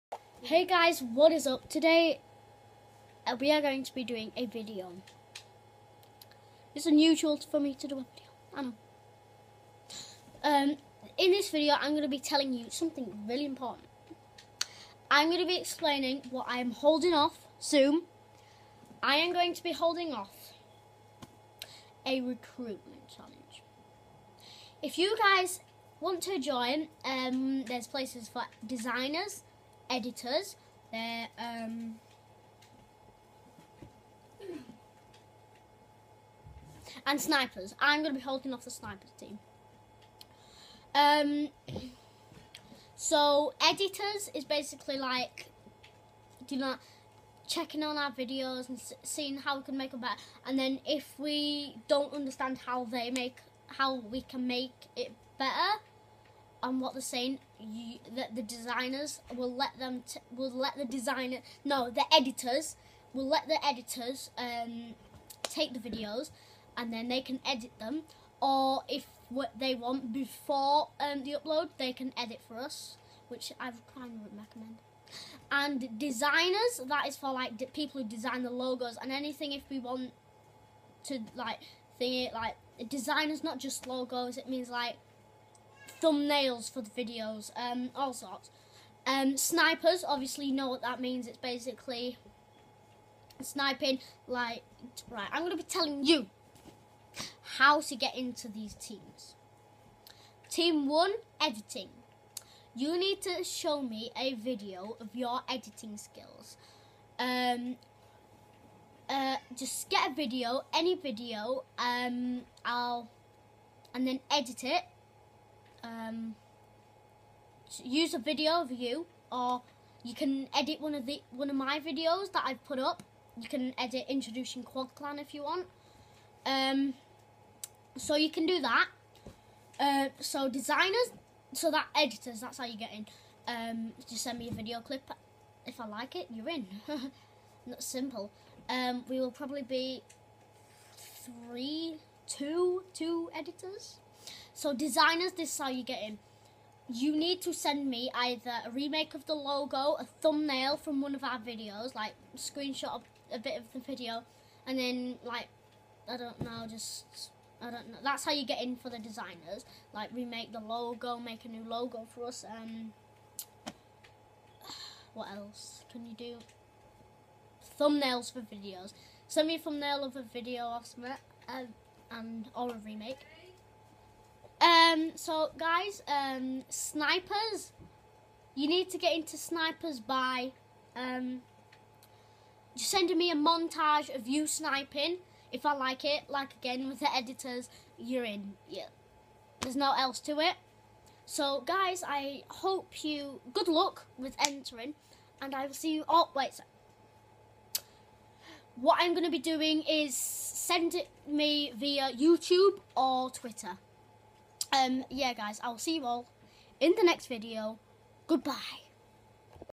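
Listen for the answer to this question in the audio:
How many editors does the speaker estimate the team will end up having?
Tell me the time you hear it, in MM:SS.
02:22.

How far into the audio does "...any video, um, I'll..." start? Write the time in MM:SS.
01:50.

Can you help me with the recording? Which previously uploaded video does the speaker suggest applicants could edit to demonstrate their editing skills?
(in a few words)
Introducing Quad Clan.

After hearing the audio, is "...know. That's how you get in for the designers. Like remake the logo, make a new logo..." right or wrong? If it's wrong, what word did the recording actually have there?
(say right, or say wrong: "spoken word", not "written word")
right.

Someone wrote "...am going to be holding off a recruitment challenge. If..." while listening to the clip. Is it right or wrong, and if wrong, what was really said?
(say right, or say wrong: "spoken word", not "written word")
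right.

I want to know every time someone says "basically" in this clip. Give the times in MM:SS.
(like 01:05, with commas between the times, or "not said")
00:44, 01:31.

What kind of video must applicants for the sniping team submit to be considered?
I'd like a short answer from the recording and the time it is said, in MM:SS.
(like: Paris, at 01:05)
A montage, at 03:03.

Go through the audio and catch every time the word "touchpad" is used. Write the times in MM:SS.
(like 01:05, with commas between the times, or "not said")
not said.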